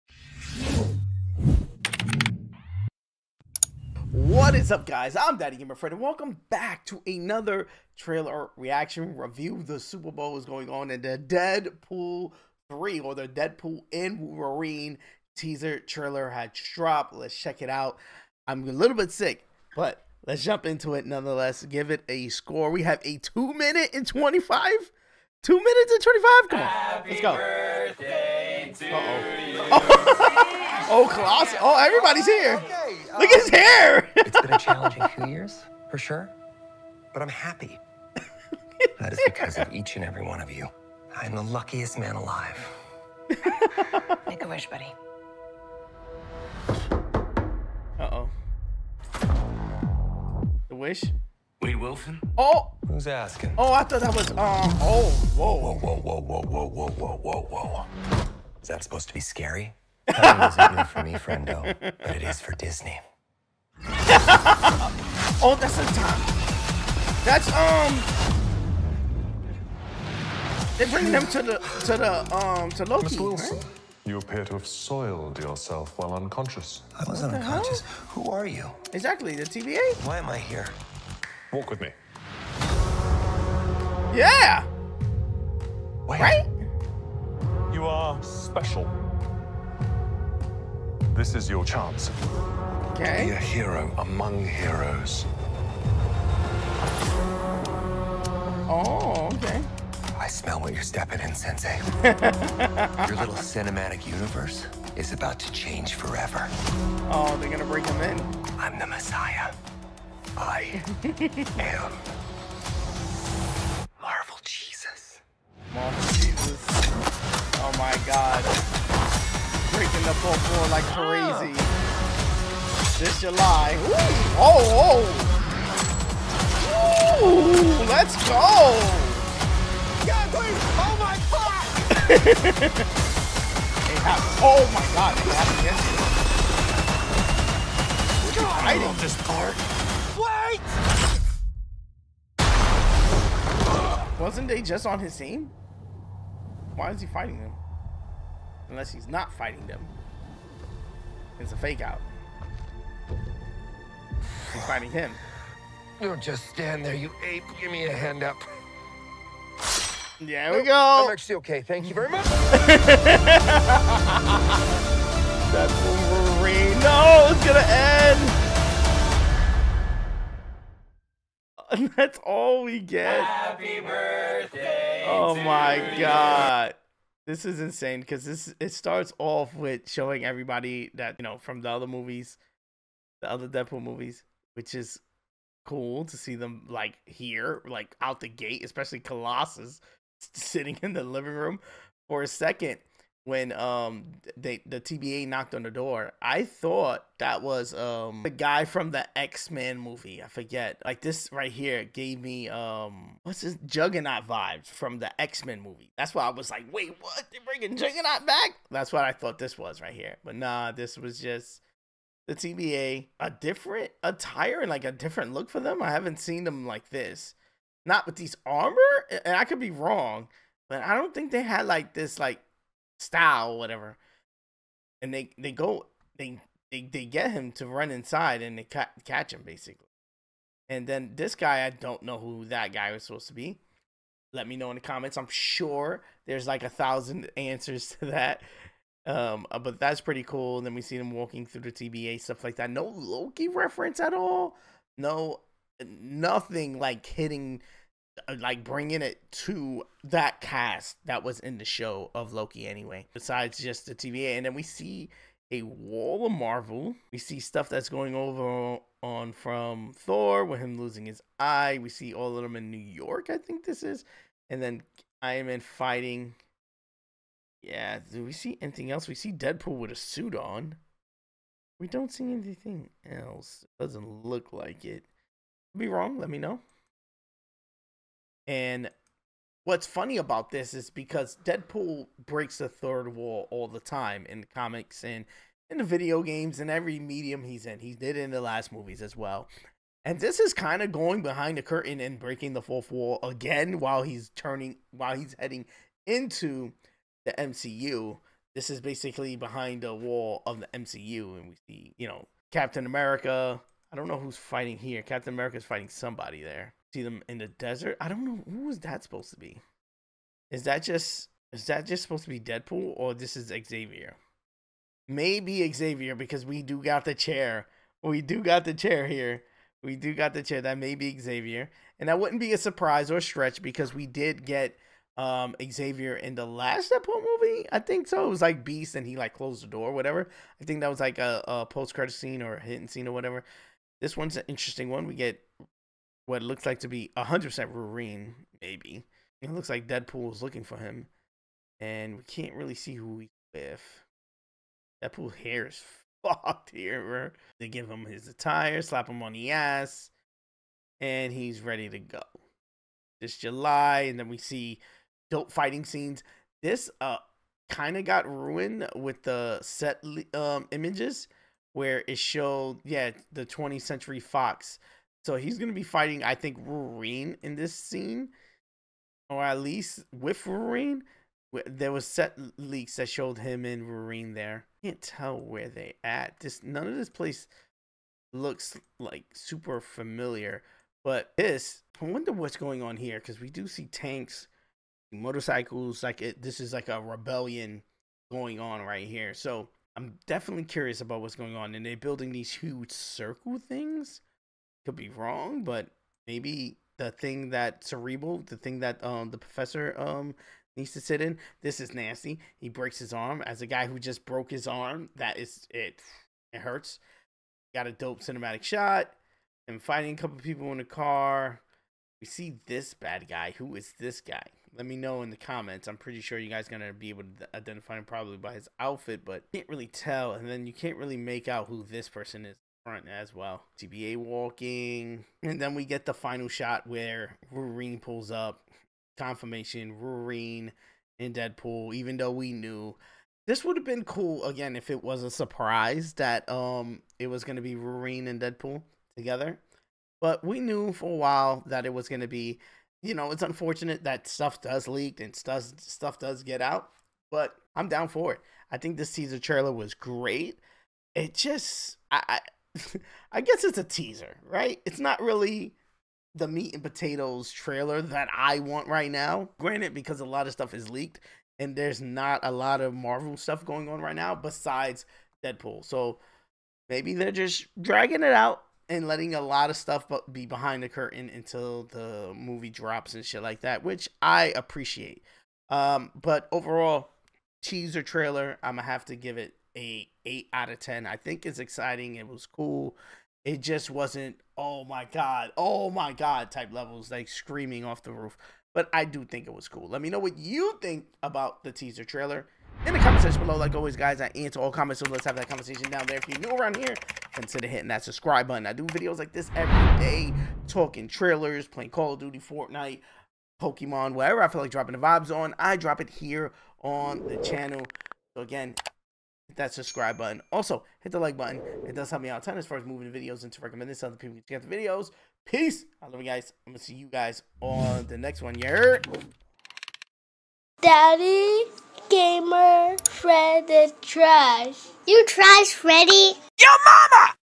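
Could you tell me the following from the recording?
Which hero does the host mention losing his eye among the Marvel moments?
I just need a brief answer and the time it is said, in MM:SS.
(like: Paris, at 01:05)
Thor, at 04:19.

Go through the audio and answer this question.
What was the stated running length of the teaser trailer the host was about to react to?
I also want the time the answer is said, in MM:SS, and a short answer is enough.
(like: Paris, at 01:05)
2 minutes and 25, at 00:25.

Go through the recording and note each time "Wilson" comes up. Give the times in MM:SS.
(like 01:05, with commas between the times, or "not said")
00:51, 01:13.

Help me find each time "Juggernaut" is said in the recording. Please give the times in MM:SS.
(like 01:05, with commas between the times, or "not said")
03:23, 03:27.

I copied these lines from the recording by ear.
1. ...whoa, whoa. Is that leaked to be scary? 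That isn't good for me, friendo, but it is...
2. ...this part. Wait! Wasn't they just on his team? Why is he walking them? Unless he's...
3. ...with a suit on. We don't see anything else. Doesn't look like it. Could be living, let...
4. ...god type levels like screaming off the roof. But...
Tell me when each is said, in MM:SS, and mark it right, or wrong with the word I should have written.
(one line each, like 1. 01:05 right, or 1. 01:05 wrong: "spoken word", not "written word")
1. 00:57 wrong: "supposed", not "leaked"
2. 02:18 wrong: "fighting", not "walking"
3. 04:29 wrong: "wrong", not "living"
4. 08:06 right.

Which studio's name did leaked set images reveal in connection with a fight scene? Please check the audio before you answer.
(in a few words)
20th Century Fox.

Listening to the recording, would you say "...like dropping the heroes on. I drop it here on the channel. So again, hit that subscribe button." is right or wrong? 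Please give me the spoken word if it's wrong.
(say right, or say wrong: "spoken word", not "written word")
wrong: "vibes", not "heroes".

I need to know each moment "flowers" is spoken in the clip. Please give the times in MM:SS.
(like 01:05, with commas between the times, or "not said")
not said.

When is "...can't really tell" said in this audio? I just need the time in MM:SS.
06:59.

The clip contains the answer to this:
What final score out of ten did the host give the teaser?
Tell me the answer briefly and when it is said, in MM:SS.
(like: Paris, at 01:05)
8, at 08:00.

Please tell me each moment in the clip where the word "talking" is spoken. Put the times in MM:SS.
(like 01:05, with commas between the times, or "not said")
08:20.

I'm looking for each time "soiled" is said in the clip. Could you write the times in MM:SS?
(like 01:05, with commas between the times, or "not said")
01:14.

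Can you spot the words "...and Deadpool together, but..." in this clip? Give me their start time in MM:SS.
07:18.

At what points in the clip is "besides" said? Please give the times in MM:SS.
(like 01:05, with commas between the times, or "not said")
04:13, 07:44.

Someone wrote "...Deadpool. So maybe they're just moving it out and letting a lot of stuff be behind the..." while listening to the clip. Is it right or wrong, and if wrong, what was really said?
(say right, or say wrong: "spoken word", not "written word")
wrong: "dragging", not "moving".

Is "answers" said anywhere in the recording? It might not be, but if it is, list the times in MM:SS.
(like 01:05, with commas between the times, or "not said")
03:57, 08:14.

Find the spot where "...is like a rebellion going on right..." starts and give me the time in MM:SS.
06:26.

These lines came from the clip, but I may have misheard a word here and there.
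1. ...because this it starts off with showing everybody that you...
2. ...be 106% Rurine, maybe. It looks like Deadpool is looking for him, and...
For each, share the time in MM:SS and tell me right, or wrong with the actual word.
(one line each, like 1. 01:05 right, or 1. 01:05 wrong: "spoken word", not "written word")
1. 02:57 right
2. 05:36 wrong: "100", not "106".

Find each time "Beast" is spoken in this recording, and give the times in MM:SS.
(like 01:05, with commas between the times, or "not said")
05:28.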